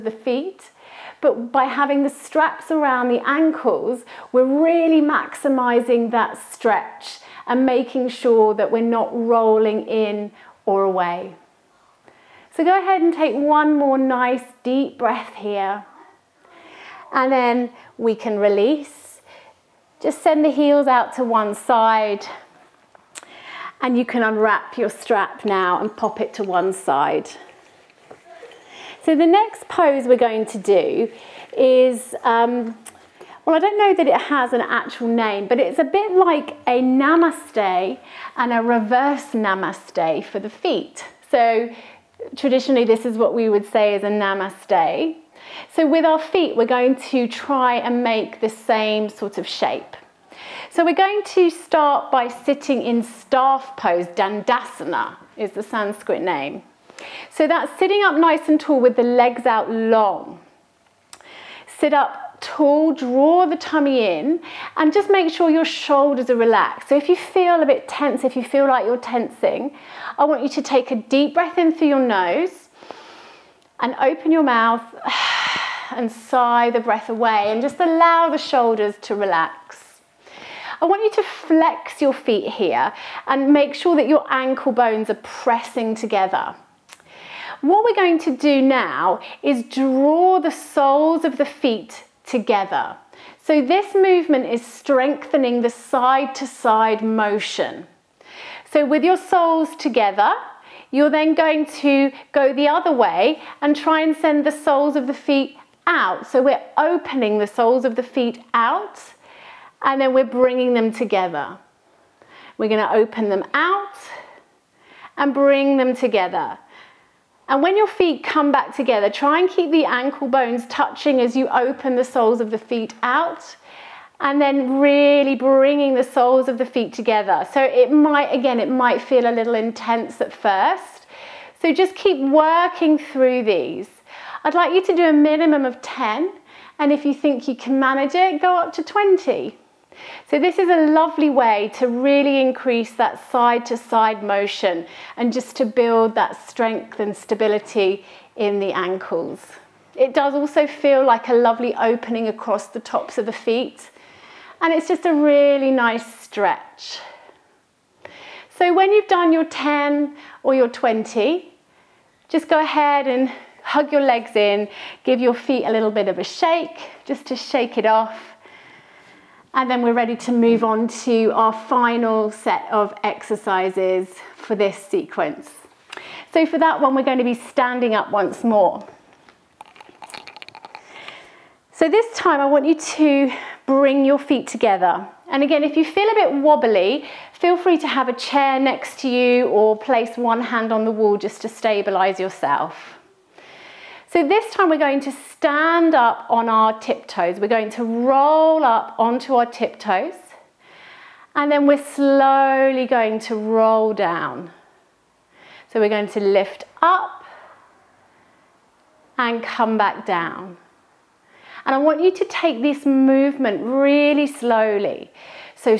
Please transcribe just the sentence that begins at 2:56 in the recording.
So for that one, we're going to be standing up once more.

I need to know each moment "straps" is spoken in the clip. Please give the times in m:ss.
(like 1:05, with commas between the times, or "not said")
0:02, 0:24.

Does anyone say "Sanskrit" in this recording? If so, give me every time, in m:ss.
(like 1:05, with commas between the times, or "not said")
0:55.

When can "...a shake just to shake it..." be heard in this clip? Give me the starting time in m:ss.
2:46.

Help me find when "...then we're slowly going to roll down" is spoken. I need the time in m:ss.
3:21.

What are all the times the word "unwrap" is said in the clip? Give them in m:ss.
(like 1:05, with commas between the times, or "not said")
0:24.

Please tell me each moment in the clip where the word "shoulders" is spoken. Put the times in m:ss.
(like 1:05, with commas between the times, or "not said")
1:05, 1:18.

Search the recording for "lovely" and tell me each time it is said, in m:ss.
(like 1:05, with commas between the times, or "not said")
2:20, 2:31.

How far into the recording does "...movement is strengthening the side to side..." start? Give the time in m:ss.
1:33.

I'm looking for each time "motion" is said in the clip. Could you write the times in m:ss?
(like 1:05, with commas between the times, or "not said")
1:37, 2:24.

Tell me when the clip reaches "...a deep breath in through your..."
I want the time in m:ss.
1:10.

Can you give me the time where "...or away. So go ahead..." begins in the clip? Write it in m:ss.
0:10.